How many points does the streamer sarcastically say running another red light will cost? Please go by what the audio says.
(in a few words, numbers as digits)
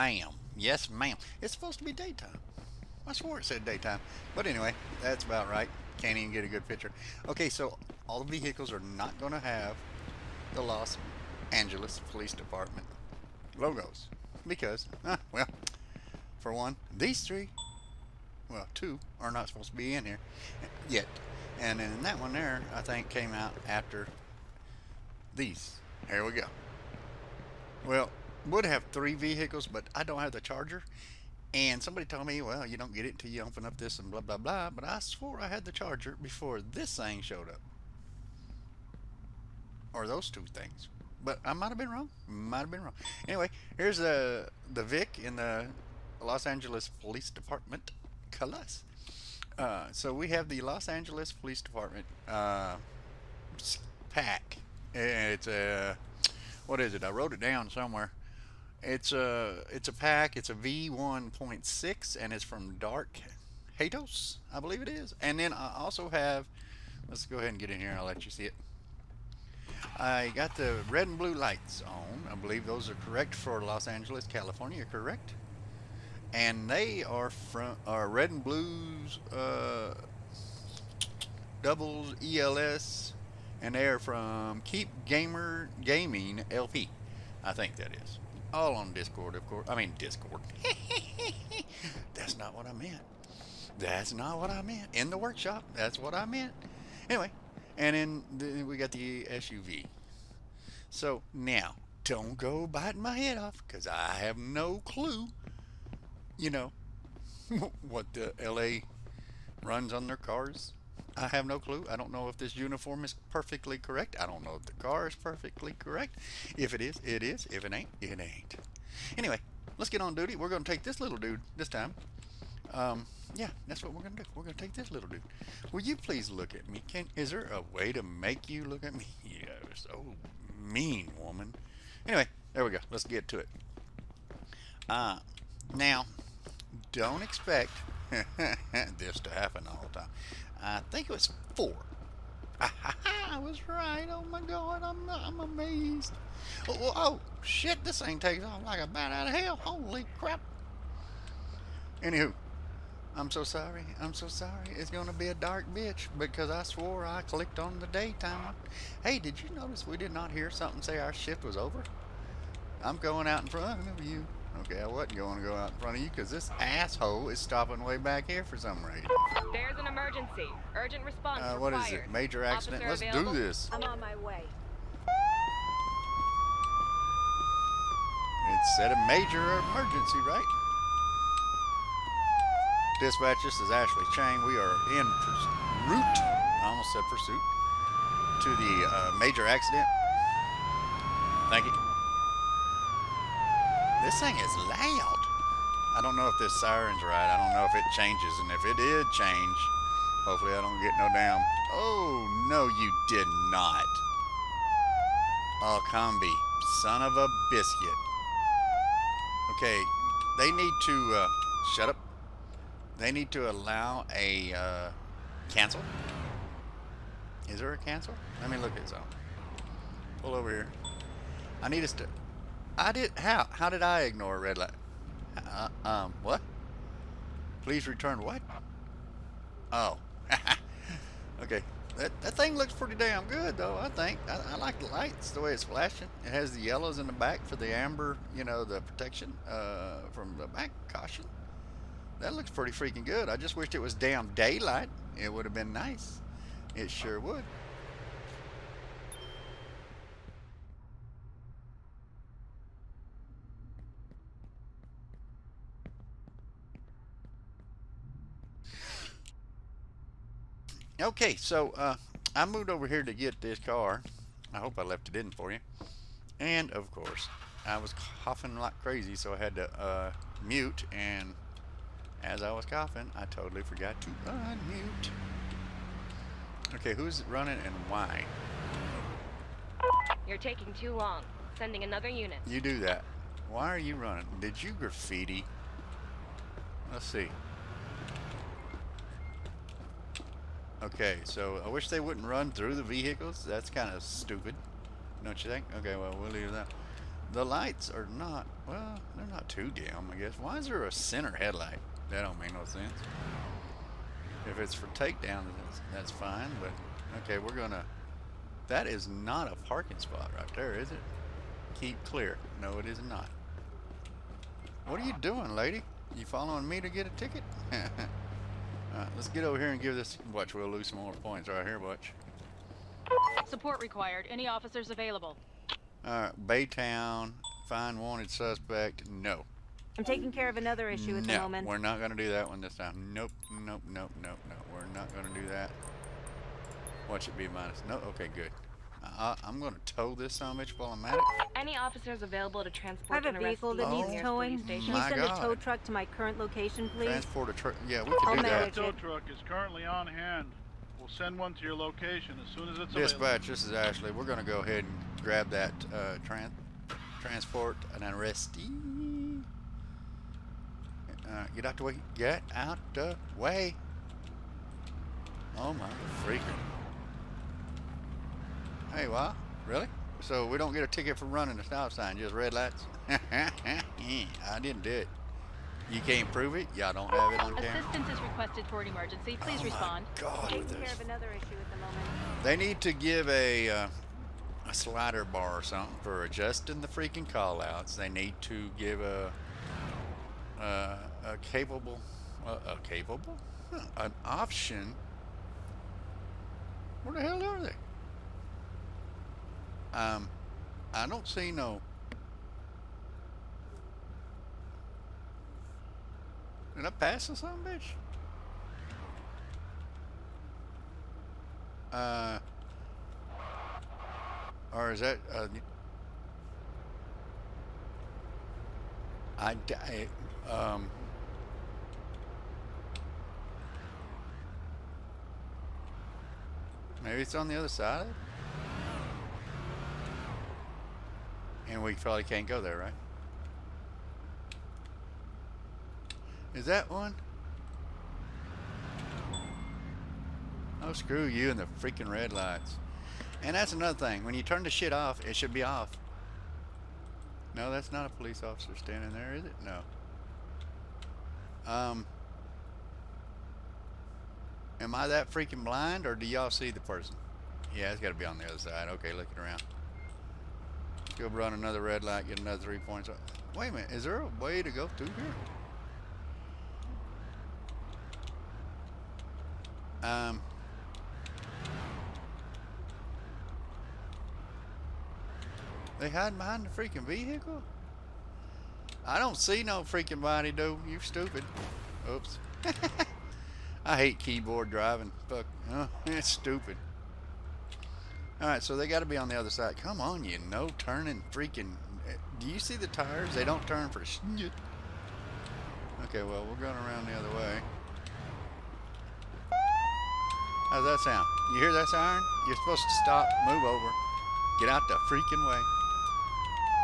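3.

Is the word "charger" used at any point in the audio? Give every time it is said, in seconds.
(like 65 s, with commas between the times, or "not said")
30 s, 35 s.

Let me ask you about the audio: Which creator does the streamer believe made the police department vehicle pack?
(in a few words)
Dark Hatos.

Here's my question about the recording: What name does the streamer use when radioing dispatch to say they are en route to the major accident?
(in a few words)
Ashley Chang.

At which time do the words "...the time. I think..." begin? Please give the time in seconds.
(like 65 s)
139 s.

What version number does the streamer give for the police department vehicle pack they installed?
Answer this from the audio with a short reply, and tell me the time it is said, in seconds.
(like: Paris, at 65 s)
V1.6, at 60 s.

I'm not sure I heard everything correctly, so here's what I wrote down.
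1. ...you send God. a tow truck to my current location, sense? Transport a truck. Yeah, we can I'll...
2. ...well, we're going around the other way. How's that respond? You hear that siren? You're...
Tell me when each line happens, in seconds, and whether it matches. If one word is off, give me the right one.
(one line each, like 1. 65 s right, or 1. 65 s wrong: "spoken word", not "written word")
1. 344 s wrong: "please", not "sense"
2. 496 s wrong: "sound", not "respond".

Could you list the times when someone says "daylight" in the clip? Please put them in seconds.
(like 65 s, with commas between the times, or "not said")
244 s.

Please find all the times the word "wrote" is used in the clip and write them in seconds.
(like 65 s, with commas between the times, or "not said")
57 s.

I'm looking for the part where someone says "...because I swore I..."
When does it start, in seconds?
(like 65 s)
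156 s.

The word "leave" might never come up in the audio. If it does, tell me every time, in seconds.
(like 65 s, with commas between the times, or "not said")
296 s.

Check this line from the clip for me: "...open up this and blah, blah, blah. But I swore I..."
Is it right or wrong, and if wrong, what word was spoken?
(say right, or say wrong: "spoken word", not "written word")
right.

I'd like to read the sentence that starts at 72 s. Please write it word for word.
I believe those are correct for Los Angeles, California, correct?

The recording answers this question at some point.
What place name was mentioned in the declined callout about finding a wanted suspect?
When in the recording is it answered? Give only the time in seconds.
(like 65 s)
326 s.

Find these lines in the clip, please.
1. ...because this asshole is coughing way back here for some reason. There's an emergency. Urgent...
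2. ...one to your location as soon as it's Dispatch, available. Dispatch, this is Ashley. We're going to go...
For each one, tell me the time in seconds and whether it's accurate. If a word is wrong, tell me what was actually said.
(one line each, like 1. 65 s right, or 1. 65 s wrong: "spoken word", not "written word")
1. 166 s wrong: "stopping", not "coughing"
2. 351 s right.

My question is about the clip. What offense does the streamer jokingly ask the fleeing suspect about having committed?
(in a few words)
Graffiti.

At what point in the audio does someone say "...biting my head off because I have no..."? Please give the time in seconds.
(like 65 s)
102 s.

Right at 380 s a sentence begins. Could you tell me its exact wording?
God, Taking care of another issue at the moment.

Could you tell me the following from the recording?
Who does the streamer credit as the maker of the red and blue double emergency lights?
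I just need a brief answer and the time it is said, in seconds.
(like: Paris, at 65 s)
Keep Gamer Gaming LP, at 84 s.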